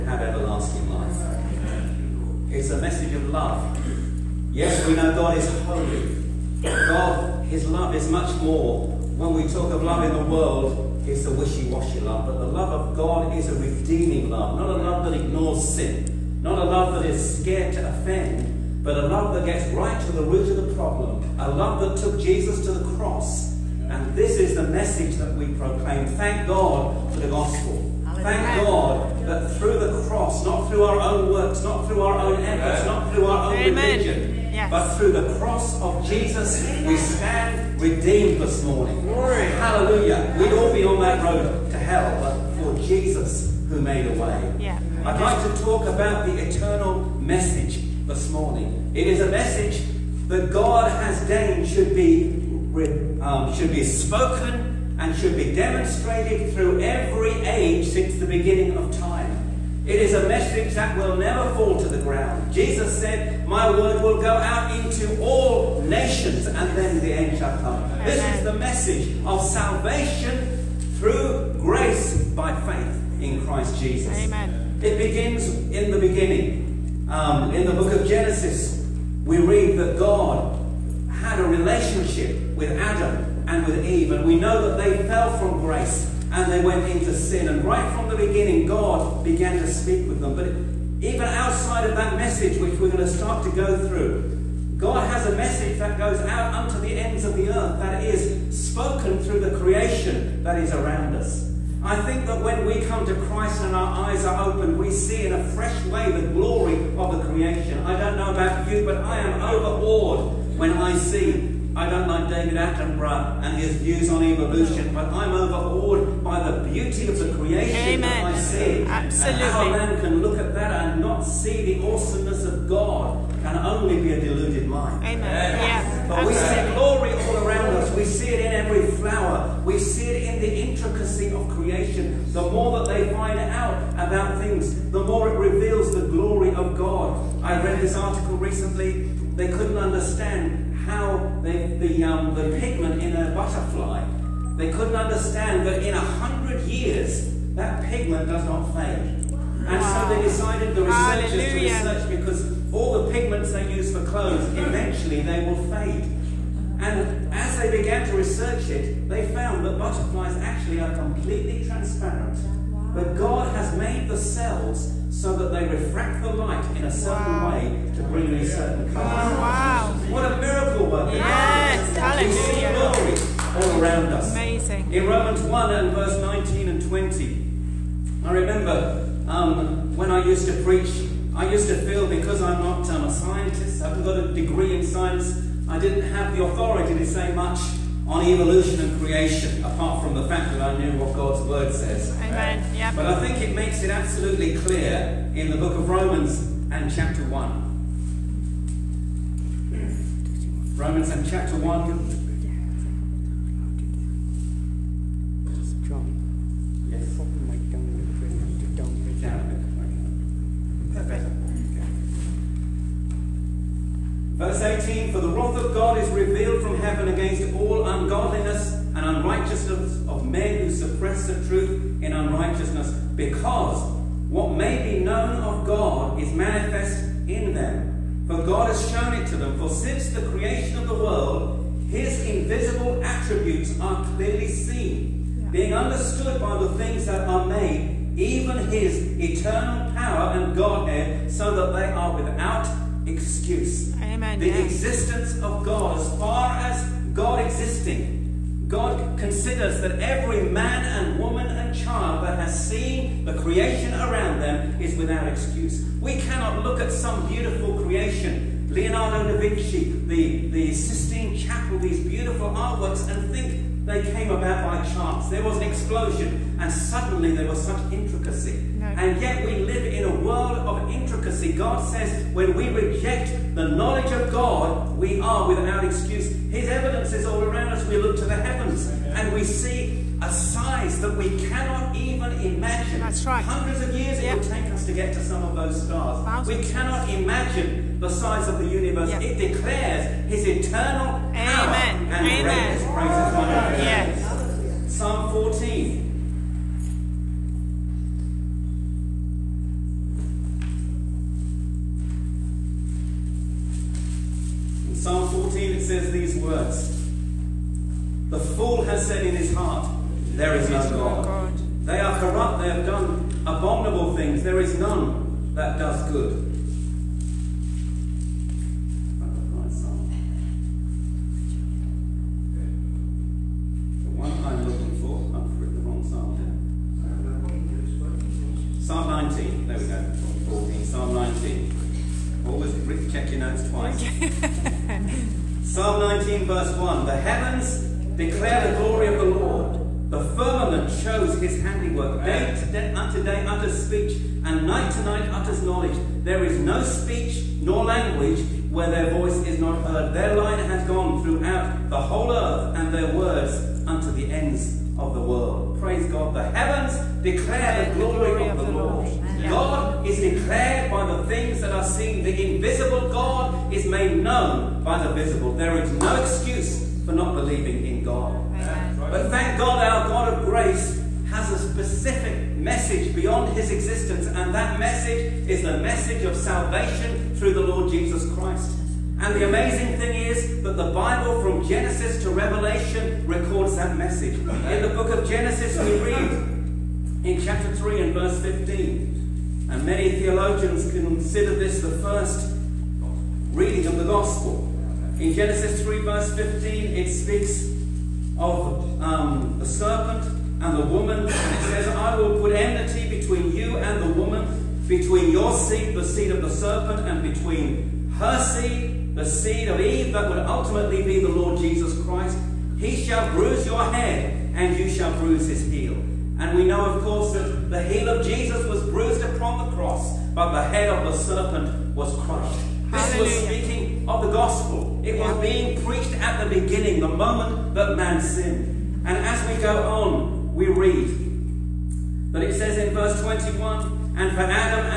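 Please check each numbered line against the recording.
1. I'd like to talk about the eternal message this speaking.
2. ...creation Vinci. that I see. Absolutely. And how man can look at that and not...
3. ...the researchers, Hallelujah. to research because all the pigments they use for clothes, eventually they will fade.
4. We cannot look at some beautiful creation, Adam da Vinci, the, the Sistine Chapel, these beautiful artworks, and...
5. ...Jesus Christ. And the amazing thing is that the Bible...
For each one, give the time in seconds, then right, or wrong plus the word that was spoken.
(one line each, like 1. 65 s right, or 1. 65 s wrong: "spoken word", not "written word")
1. 45 s wrong: "morning", not "speaking"
2. 117 s wrong: "Amen", not "Vinci"
3. 150 s right
4. 256 s wrong: "Leonardo", not "Adam"
5. 377 s right.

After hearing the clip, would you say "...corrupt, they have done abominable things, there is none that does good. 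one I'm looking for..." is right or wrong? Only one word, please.
right.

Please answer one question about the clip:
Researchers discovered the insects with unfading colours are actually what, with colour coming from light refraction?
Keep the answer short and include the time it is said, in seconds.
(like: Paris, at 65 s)
Completely transparent, at 160 s.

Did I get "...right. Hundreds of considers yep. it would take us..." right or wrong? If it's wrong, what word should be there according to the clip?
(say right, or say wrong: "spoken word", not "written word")
wrong: "years", not "considers".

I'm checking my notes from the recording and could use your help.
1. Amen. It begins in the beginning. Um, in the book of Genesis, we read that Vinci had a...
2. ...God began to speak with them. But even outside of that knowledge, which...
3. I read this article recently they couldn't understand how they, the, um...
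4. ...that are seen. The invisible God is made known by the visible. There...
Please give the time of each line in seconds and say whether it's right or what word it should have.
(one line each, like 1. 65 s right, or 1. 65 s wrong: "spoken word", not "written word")
1. 74 s wrong: "God", not "Vinci"
2. 88 s wrong: "message", not "knowledge"
3. 137 s right
4. 361 s right.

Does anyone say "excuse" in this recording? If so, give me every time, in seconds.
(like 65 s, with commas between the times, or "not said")
243 s, 255 s, 275 s, 366 s.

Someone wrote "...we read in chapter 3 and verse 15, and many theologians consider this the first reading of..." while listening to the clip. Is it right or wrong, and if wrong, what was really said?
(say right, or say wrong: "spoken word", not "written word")
right.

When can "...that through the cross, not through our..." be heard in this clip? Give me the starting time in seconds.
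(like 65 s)
29 s.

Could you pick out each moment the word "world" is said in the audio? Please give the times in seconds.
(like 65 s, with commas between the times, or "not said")
10 s, 230 s, 270 s, 355 s.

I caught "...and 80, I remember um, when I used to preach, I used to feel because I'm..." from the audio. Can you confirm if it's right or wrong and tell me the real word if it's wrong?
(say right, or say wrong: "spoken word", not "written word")
wrong: "20", not "80".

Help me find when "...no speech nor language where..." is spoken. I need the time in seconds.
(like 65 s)
346 s.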